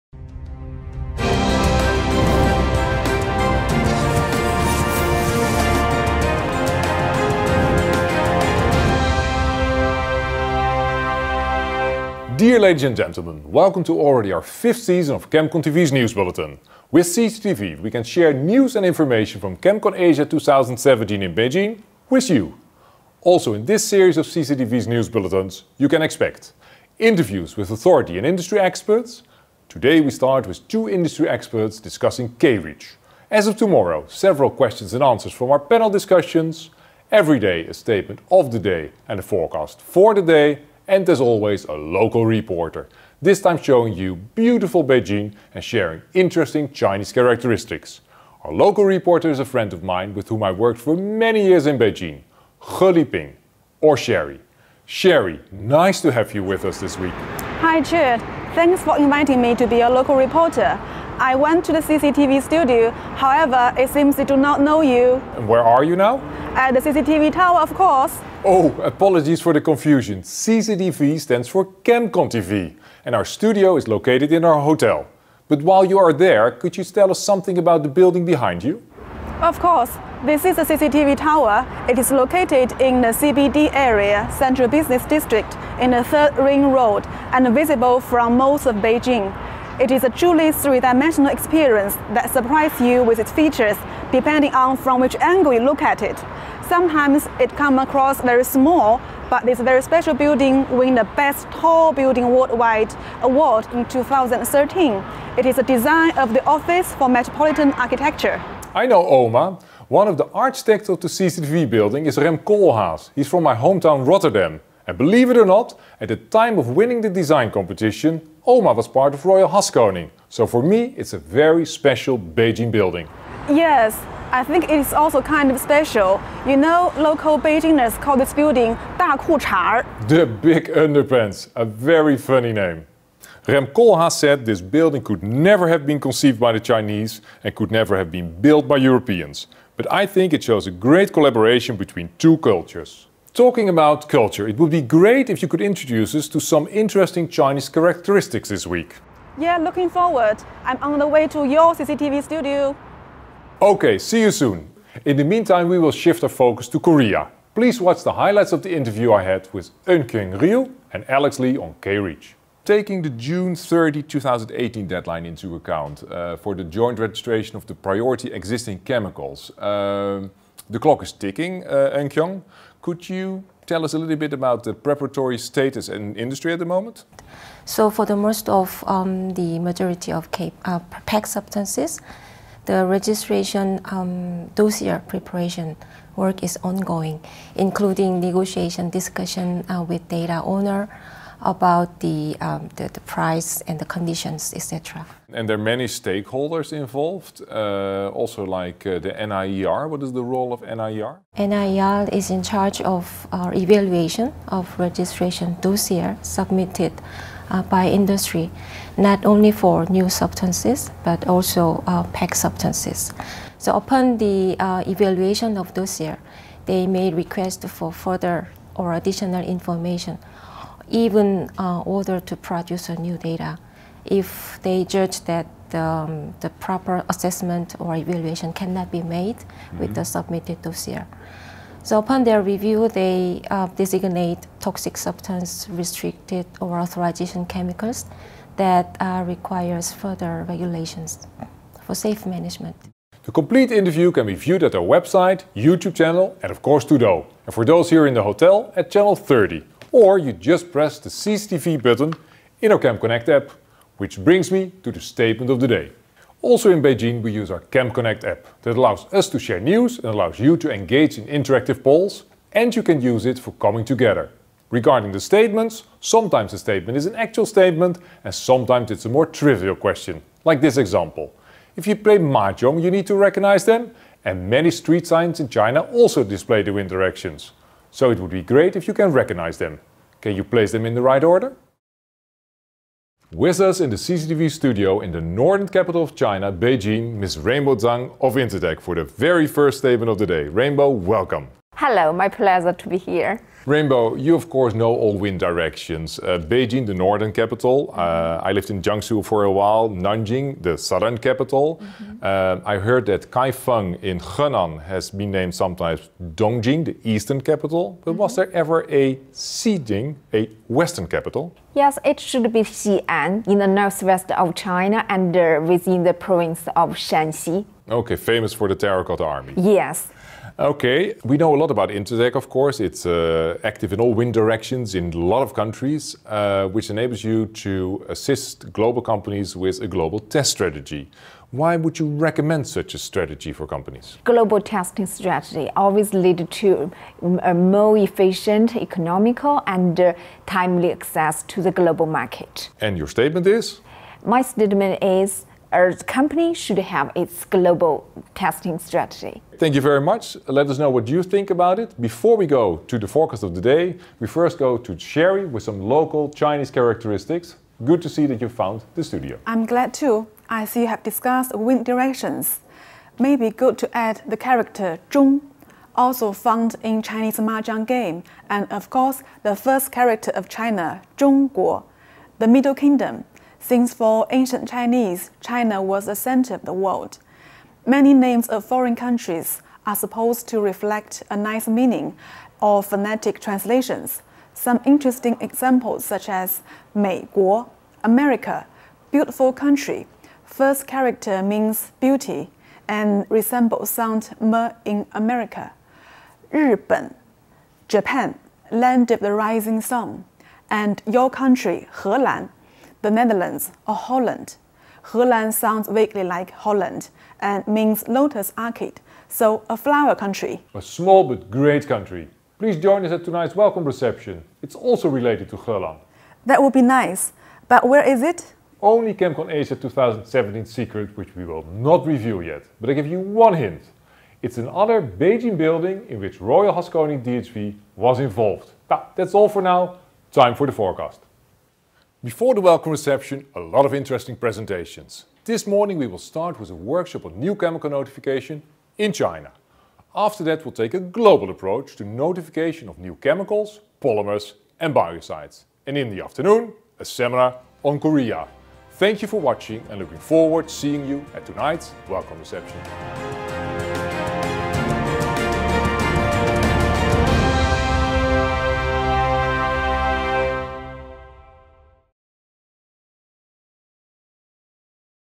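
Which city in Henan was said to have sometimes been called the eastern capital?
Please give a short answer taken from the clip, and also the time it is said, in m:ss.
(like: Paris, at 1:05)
Kaifeng, at 5:03.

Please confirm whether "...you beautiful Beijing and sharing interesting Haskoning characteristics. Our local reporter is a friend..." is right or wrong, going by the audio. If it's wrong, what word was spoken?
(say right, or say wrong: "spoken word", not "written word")
wrong: "Chinese", not "Haskoning".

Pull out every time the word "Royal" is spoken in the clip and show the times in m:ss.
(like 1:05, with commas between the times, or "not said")
1:59, 7:06.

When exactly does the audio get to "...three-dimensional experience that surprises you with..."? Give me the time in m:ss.
1:30.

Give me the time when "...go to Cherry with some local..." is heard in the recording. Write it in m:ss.
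5:54.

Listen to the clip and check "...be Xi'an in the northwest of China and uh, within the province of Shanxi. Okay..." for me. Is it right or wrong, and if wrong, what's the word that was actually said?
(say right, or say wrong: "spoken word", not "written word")
right.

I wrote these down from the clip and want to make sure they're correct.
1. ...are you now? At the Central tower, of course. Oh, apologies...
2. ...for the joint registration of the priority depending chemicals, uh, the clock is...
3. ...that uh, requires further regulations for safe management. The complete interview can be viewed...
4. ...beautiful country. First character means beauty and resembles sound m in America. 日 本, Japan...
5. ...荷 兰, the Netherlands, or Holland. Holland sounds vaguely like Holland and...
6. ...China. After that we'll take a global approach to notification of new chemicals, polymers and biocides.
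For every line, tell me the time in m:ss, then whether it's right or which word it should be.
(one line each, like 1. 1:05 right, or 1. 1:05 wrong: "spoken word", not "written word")
1. 1:05 wrong: "CCTV", not "Central"
2. 2:46 wrong: "existing", not "depending"
3. 3:58 right
4. 6:29 right
5. 6:41 right
6. 7:19 right.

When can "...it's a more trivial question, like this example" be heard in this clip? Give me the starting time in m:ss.
4:28.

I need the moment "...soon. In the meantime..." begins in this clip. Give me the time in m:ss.
2:34.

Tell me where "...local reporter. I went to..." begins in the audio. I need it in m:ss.
0:59.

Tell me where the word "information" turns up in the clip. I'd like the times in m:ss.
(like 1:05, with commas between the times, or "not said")
0:18, 3:39.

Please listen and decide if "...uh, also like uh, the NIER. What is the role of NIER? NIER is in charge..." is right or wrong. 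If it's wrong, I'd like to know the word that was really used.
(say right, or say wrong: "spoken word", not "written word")
right.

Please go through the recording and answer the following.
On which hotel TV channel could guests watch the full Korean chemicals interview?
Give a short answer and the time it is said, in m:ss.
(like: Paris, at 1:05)
Channel 30, at 4:08.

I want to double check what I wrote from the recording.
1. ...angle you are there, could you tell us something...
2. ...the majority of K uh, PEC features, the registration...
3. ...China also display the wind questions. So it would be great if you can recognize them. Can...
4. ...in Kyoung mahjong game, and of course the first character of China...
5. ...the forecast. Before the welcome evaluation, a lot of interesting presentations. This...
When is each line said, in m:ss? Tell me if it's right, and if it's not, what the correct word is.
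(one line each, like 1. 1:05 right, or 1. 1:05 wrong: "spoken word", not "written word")
1. 1:15 wrong: "while", not "angle"
2. 2:59 wrong: "substances", not "features"
3. 4:35 wrong: "directions", not "questions"
4. 6:06 wrong: "Chinese", not "Kyoung"
5. 7:10 wrong: "reception", not "evaluation".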